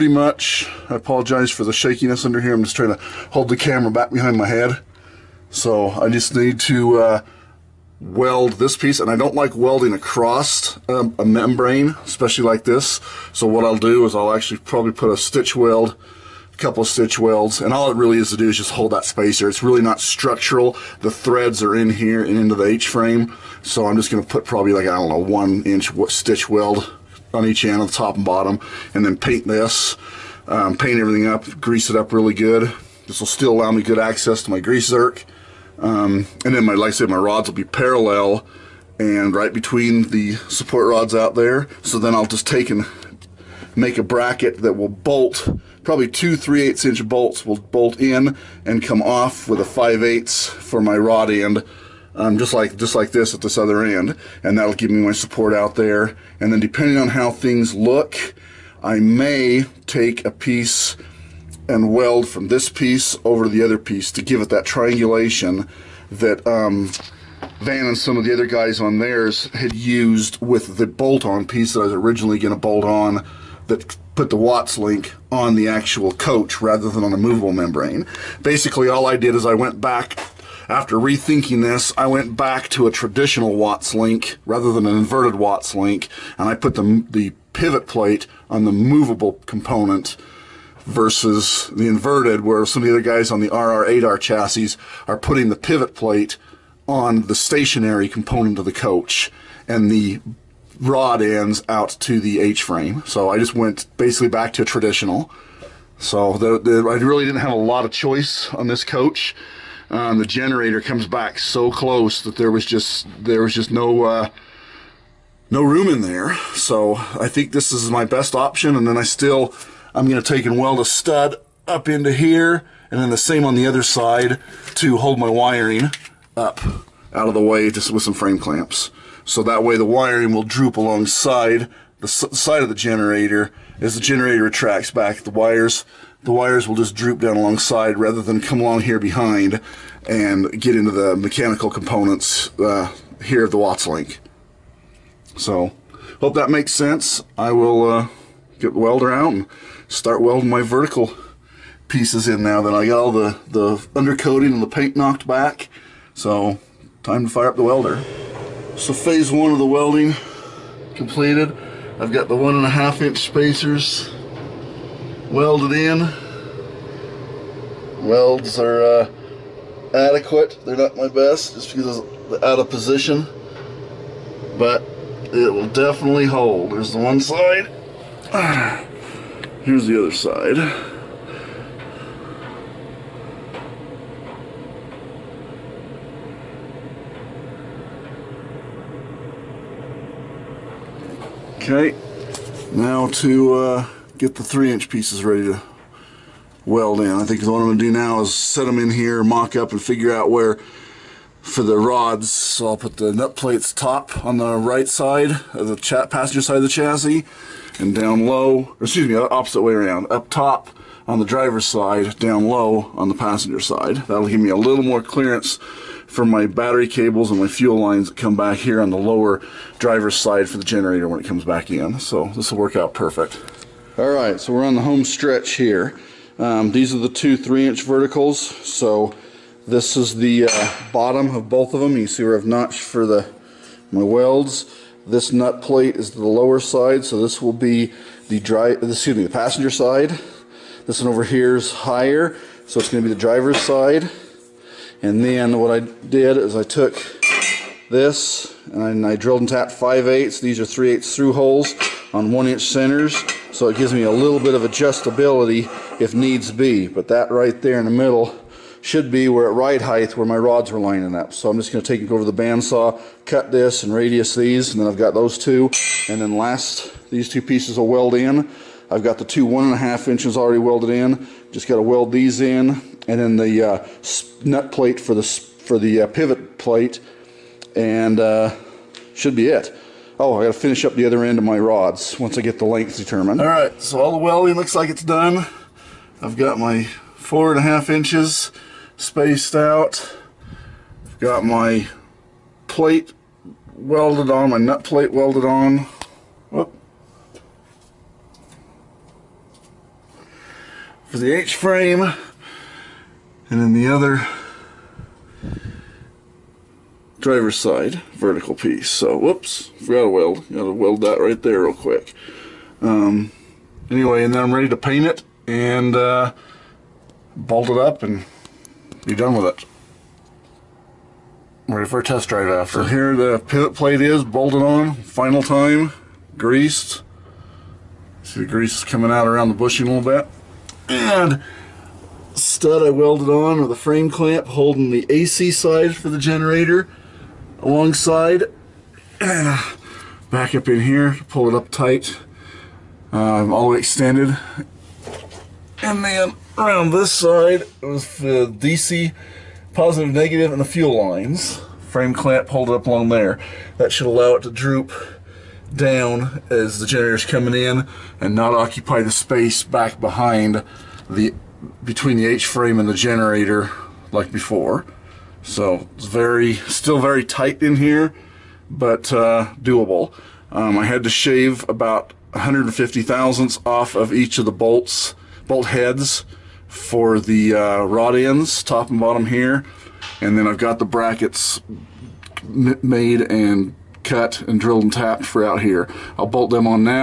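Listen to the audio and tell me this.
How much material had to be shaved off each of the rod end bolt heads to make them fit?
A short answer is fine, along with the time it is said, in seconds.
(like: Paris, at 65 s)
150 thousandths, at 372 s.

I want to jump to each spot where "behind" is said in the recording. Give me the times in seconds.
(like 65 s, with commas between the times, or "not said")
4 s, 138 s, 360 s.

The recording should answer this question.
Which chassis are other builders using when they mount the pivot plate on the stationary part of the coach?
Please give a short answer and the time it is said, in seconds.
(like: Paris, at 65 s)
RR8R, at 93 s.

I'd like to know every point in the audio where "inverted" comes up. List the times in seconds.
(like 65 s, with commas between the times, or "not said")
84 s, 91 s.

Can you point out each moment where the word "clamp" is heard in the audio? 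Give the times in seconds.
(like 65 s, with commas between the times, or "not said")
128 s, 334 s, 352 s.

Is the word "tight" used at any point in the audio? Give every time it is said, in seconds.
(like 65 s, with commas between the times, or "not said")
341 s, 367 s.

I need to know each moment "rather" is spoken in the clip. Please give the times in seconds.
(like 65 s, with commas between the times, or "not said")
76 s, 84 s, 137 s.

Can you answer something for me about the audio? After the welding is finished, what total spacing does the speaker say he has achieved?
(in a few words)
4.5 inches.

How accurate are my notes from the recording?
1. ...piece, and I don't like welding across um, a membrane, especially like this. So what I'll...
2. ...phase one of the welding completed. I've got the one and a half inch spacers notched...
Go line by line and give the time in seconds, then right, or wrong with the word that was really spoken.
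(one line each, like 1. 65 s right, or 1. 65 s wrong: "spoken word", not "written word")
1. 8 s right
2. 158 s wrong: "welded", not "notched".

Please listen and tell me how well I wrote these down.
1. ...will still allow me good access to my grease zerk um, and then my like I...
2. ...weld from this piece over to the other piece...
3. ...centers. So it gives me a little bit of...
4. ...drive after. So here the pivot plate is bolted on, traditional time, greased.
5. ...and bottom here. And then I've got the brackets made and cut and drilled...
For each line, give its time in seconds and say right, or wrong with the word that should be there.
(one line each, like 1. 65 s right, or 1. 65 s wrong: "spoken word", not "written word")
1. 33 s right
2. 61 s right
3. 252 s right
4. 322 s wrong: "final", not "traditional"
5. 378 s right.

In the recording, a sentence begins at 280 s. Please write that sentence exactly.
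Oh, I got to finish up the other end of my rods once I get the length determined.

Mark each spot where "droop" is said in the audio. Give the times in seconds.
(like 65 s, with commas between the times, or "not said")
130 s, 136 s, 354 s.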